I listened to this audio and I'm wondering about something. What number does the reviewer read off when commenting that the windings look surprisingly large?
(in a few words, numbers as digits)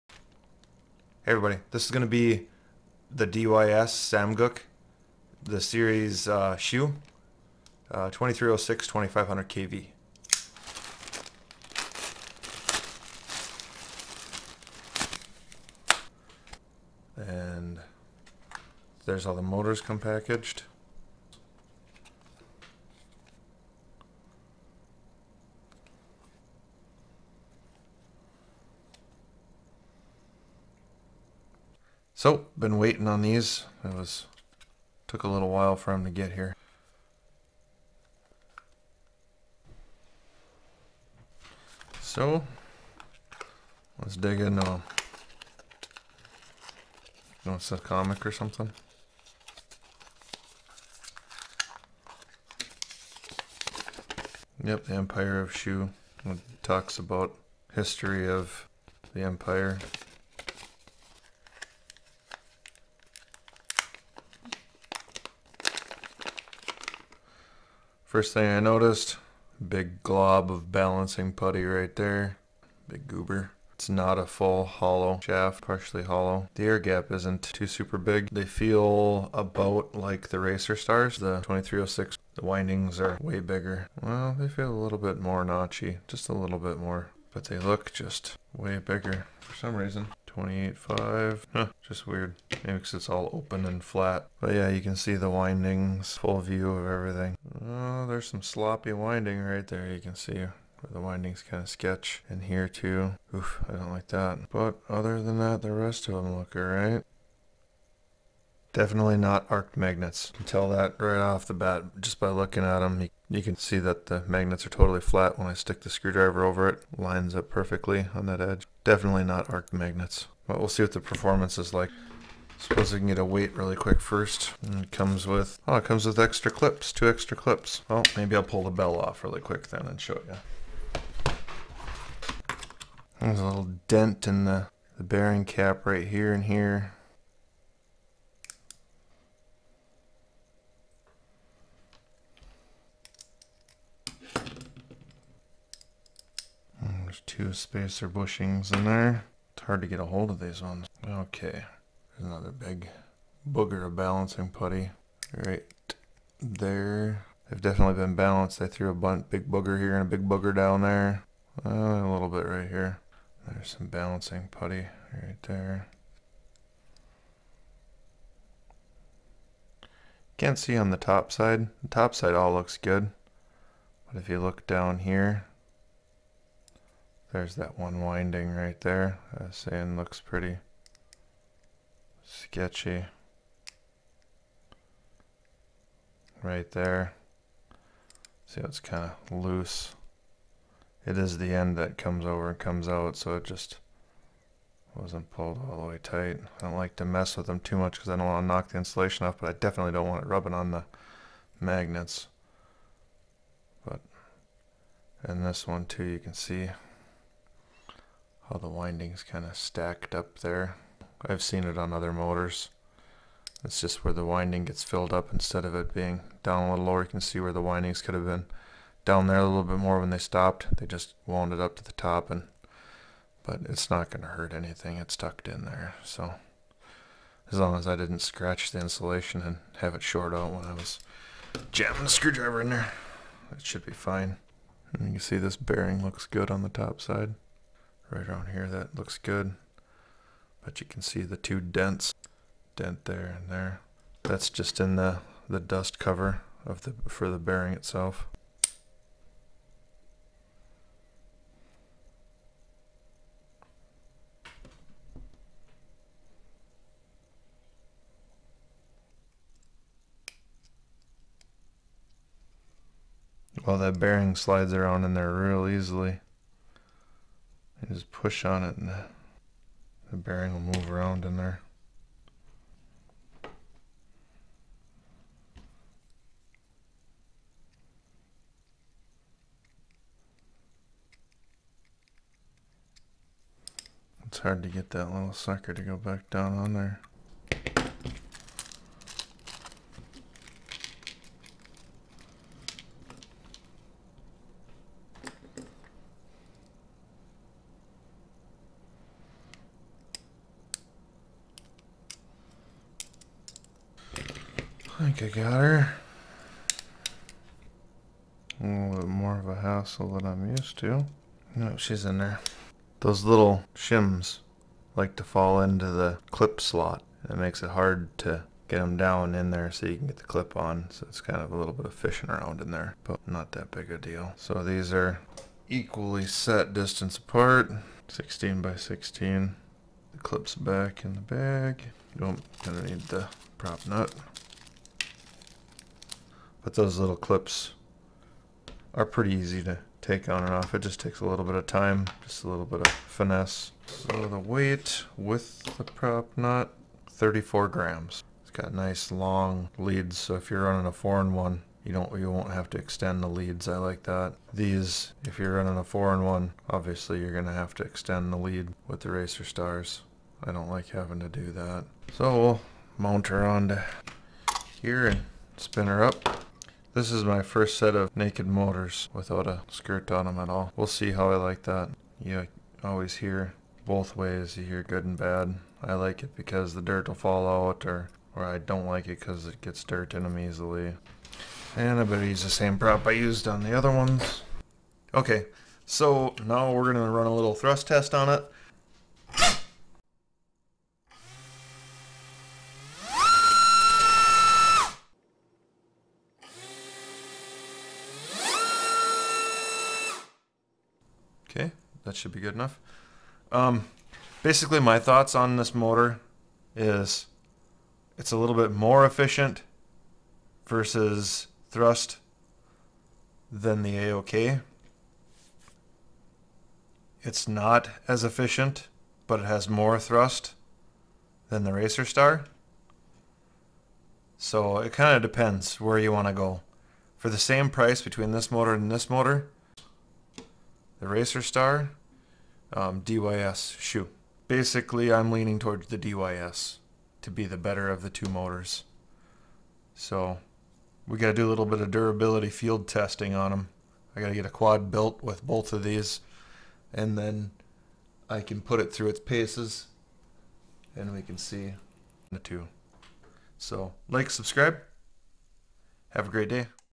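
28.5.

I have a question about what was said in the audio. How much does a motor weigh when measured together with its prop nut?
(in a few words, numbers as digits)
34 grams.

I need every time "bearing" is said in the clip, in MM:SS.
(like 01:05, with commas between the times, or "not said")
02:15, 03:55, 04:07, 04:23, 04:30.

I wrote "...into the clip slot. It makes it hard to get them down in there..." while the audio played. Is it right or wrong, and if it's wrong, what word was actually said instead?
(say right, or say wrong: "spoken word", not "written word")
right.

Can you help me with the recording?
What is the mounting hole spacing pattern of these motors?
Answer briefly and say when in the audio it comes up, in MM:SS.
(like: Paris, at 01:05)
16 by 16, at 05:28.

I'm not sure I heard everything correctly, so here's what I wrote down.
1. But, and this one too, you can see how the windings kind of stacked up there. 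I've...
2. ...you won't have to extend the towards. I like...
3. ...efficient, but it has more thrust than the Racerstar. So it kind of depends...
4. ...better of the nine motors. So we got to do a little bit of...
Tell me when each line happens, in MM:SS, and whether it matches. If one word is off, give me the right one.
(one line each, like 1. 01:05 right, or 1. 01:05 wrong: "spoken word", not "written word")
1. 03:23 right
2. 05:52 wrong: "leads", not "towards"
3. 06:58 right
4. 07:17 wrong: "two", not "nine".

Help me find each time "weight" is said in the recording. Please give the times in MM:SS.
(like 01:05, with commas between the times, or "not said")
02:03, 05:44.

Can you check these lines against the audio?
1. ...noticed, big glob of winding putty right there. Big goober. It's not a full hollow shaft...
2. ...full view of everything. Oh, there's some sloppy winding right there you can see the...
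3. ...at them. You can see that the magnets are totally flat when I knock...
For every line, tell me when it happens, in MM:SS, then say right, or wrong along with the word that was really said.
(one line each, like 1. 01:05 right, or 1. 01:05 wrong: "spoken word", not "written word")
1. 01:08 wrong: "balancing", not "winding"
2. 01:36 right
3. 01:52 wrong: "stick", not "knock".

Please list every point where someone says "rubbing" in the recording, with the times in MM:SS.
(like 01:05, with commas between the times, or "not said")
03:20.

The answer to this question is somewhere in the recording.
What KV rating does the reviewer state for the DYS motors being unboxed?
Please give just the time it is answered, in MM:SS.
00:08.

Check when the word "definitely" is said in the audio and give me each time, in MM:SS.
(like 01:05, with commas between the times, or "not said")
01:48, 01:58, 02:37, 03:19.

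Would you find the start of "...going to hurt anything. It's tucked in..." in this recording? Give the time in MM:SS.
03:44.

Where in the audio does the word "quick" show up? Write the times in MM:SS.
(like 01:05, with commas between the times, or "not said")
02:03, 02:09.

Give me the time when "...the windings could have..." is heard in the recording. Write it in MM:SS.
03:37.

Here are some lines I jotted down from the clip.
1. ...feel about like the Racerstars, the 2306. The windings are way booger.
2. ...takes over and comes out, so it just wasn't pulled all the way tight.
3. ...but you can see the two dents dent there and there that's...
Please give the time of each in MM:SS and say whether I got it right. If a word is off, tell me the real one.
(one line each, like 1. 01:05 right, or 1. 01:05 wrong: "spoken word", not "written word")
1. 01:18 wrong: "bigger", not "booger"
2. 03:11 wrong: "comes", not "takes"
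3. 04:00 right.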